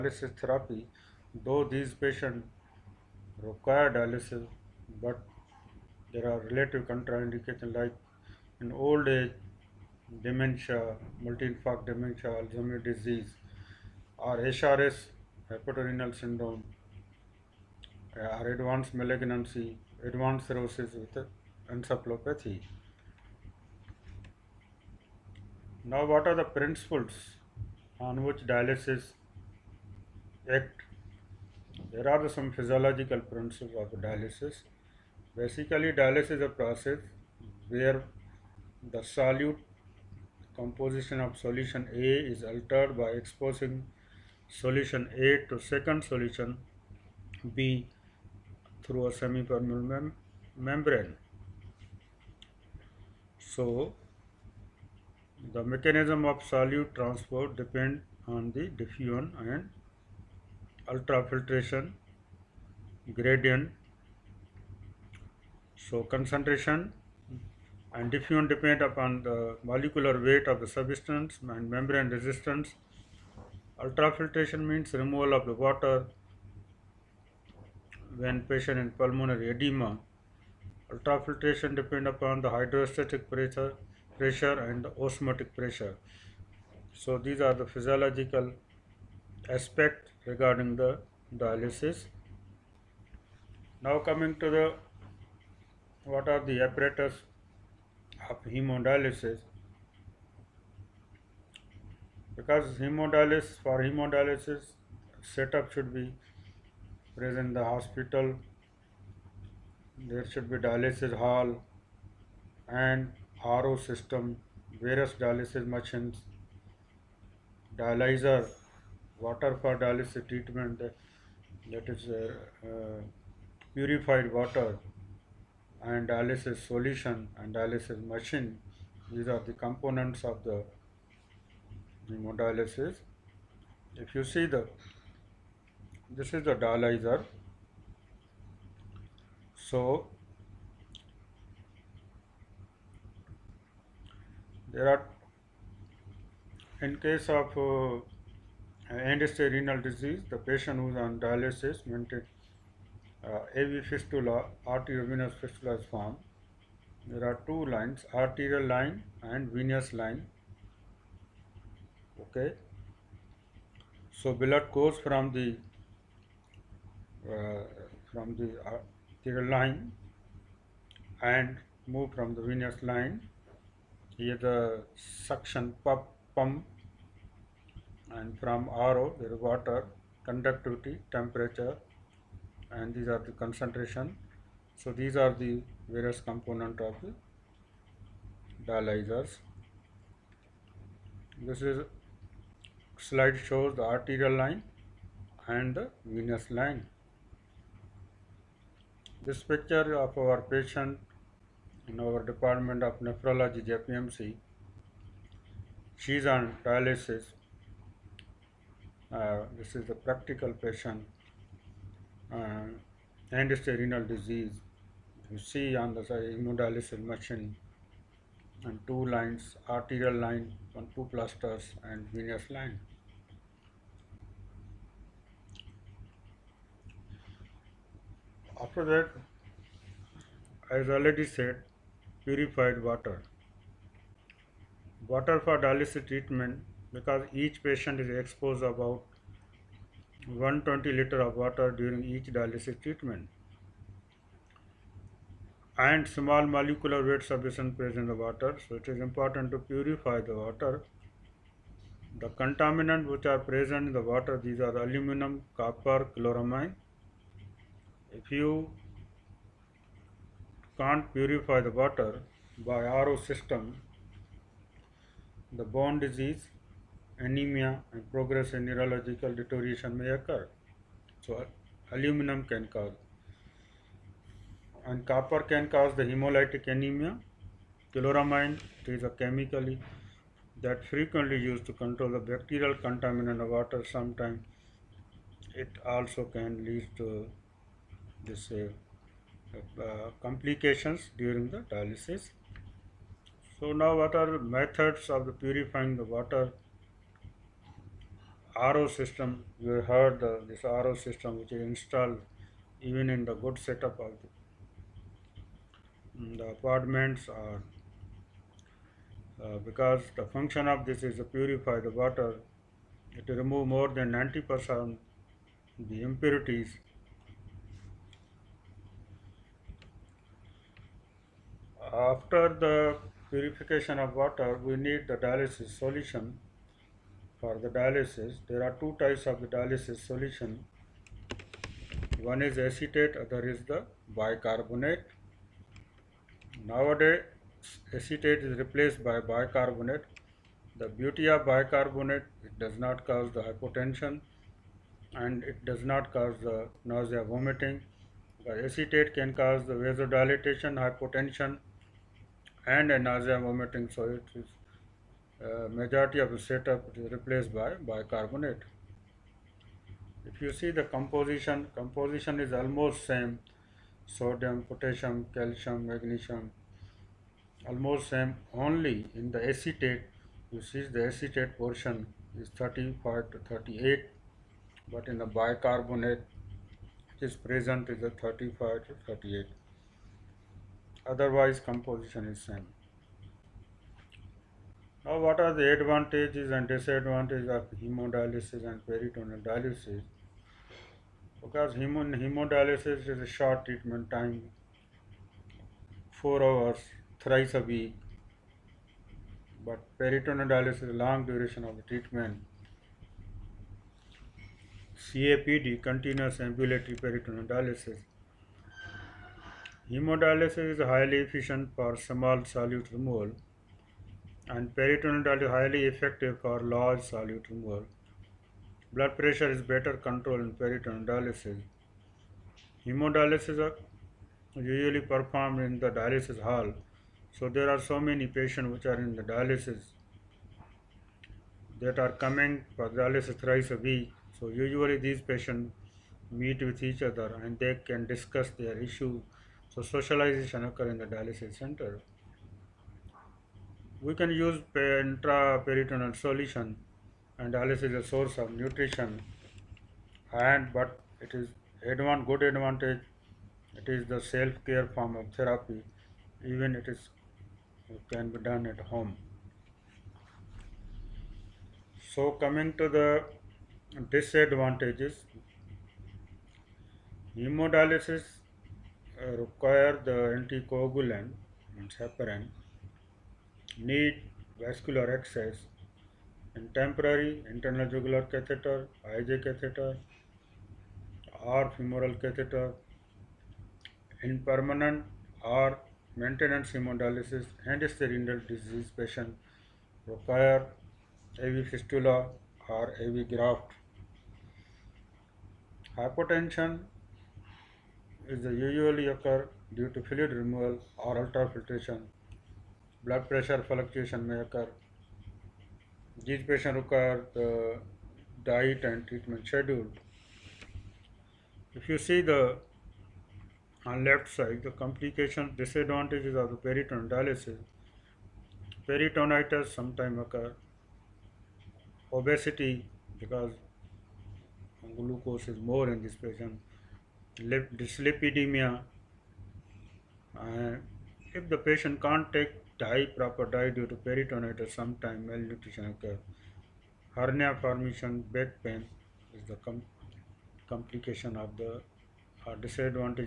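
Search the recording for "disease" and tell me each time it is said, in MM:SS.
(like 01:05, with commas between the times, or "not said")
00:12, 02:29, 03:34, 04:25, 08:08.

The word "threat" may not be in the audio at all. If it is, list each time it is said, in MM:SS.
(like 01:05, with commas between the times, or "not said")
not said.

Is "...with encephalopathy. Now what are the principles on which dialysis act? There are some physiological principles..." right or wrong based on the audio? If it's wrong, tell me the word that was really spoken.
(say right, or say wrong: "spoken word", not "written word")
right.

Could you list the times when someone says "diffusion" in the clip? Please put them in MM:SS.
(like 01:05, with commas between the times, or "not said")
00:58, 01:08.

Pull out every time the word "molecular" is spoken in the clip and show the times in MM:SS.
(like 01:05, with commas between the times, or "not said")
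01:09, 04:06.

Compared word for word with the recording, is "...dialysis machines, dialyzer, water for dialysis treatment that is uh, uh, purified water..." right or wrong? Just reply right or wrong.
right.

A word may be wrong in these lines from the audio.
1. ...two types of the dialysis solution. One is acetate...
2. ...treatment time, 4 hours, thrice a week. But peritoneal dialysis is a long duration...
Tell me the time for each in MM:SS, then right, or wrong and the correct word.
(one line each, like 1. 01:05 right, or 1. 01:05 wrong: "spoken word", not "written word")
1. 05:28 right
2. 06:33 right.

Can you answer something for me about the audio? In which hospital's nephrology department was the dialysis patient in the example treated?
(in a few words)
JPMC.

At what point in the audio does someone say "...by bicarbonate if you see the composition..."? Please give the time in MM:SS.
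05:57.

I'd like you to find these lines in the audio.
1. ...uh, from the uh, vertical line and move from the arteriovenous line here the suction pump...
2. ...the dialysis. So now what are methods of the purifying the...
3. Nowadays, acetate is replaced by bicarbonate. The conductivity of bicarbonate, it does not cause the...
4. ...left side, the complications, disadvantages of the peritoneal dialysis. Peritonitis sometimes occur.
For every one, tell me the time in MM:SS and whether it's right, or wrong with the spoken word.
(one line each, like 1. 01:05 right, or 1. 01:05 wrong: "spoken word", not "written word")
1. 02:47 wrong: "venous", not "arteriovenous"
2. 04:51 right
3. 05:36 wrong: "beauty", not "conductivity"
4. 08:34 right.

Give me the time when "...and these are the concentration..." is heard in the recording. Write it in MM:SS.
03:02.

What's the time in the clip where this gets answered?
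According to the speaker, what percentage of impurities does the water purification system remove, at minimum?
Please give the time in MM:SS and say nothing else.
05:13.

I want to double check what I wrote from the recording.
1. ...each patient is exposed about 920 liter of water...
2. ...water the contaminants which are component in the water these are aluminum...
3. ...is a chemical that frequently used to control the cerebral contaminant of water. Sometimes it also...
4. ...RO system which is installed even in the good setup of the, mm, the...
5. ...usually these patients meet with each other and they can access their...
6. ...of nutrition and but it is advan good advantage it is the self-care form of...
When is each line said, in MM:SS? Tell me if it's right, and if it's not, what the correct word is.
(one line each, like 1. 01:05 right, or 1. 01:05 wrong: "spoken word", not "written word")
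1. 03:57 wrong: "120", not "920"
2. 04:10 wrong: "present", not "component"
3. 04:38 wrong: "bacterial", not "cerebral"
4. 05:00 right
5. 07:14 wrong: "discuss", not "access"
6. 07:28 right.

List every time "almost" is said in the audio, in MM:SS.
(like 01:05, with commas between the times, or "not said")
06:02, 06:07.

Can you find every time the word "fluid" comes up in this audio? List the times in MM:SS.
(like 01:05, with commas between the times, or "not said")
08:20.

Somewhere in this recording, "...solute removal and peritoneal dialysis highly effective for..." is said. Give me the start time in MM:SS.
06:52.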